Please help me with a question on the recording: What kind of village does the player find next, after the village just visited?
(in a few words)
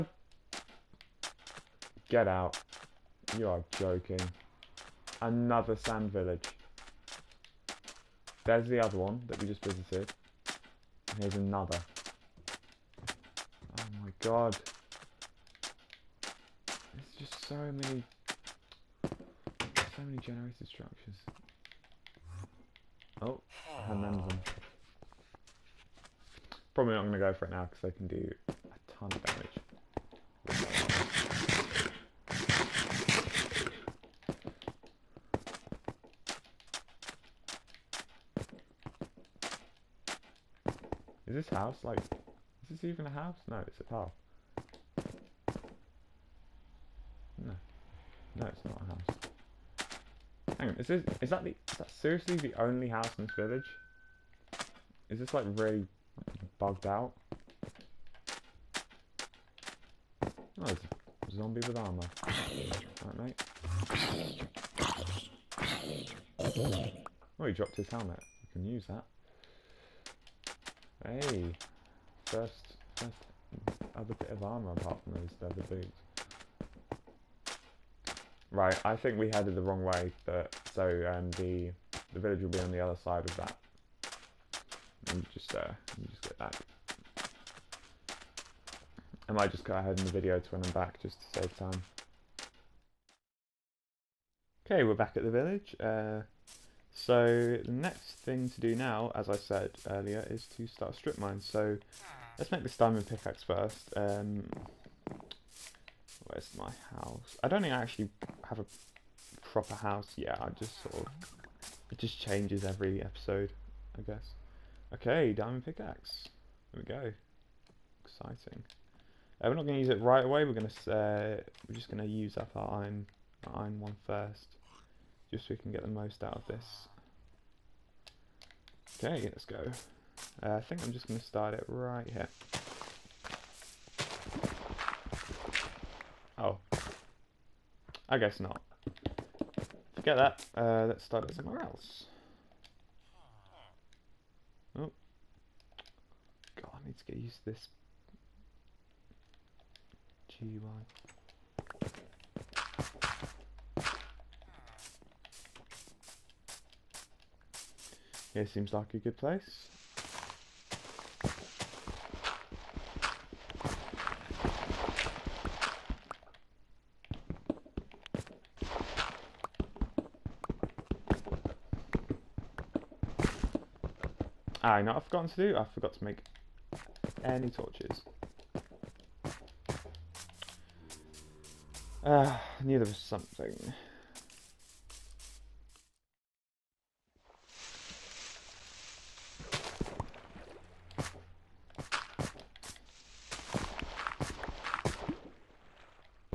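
sand village.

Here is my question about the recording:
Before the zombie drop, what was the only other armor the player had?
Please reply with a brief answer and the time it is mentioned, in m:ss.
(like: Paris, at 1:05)
leather boots, at 1:15.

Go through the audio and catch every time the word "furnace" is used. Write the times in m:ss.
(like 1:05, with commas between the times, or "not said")
not said.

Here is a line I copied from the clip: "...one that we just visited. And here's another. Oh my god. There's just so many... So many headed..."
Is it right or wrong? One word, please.
wrong.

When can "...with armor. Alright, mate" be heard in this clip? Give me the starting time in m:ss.
1:01.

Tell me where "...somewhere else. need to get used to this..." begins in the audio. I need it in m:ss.
2:21.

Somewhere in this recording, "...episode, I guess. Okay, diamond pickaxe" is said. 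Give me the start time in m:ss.
1:53.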